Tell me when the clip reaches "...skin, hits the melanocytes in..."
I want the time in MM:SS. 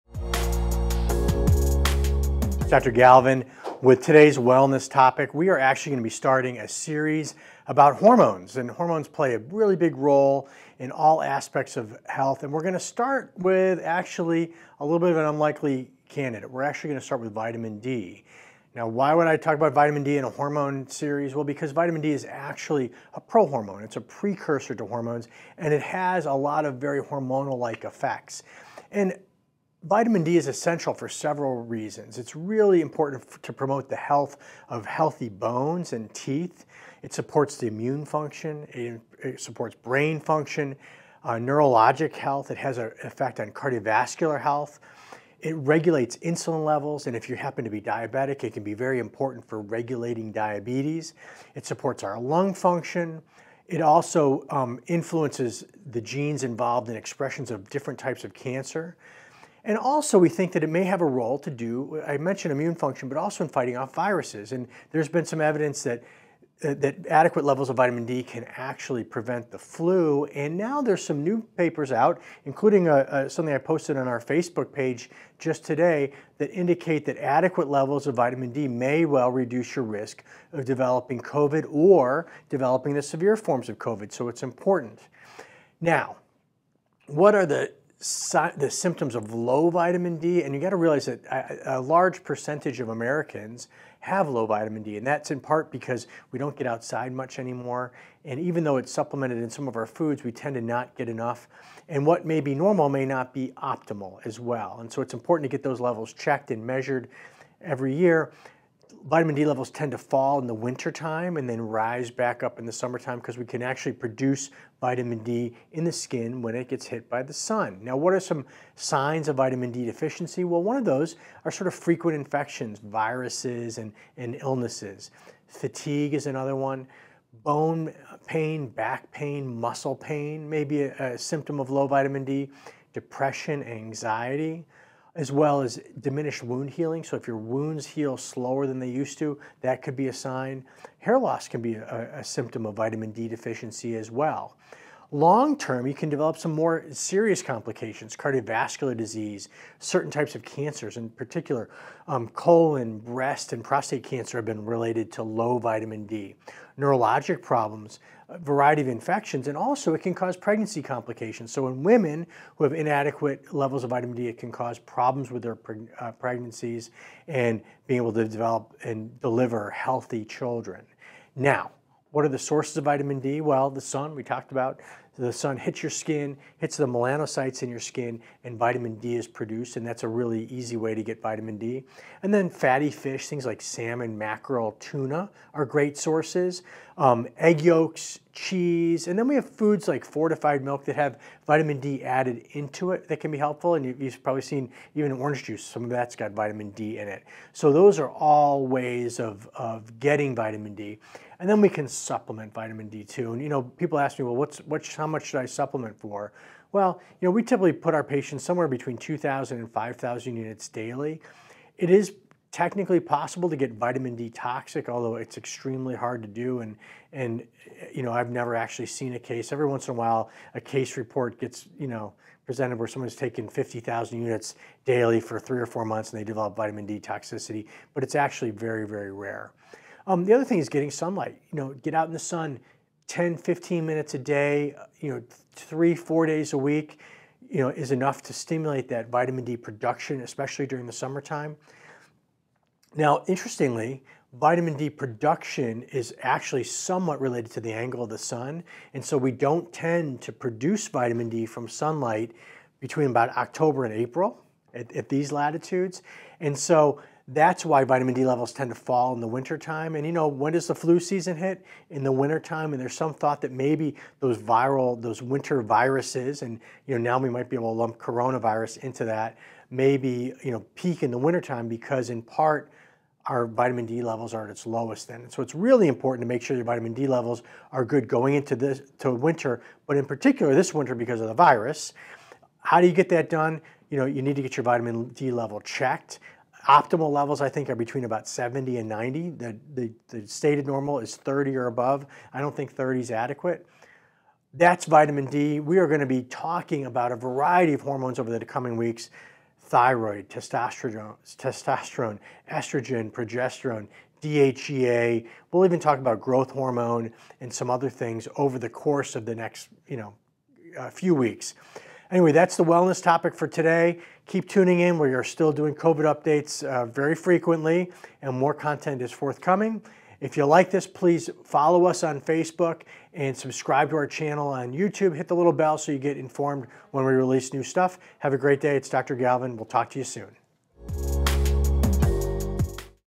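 02:55.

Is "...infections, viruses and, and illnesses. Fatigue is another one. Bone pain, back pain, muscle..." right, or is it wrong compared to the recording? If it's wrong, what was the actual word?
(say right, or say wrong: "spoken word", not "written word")
right.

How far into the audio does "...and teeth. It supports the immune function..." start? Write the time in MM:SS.
00:35.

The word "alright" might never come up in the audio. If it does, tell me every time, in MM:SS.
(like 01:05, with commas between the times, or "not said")
not said.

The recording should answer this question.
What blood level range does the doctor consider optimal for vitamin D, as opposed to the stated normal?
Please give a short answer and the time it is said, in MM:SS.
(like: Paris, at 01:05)
70 to 90, at 04:48.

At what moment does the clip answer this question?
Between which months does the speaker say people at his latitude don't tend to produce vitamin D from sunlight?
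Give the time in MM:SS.
04:13.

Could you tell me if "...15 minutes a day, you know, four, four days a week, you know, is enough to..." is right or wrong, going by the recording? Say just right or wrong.
wrong.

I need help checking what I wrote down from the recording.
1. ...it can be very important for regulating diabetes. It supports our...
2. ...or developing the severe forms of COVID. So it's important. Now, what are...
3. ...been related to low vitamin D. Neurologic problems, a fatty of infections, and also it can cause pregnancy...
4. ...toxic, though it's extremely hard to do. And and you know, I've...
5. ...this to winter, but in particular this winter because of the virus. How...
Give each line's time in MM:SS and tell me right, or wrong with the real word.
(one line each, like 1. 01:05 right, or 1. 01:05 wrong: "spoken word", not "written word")
1. 00:48 right
2. 01:21 right
3. 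02:34 wrong: "variety", not "fatty"
4. 03:34 wrong: "although", not "though"
5. 04:38 right.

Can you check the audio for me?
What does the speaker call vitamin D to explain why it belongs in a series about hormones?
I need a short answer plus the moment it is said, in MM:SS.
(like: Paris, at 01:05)
prohormone, at 00:23.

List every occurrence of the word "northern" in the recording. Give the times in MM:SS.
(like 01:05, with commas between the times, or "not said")
not said.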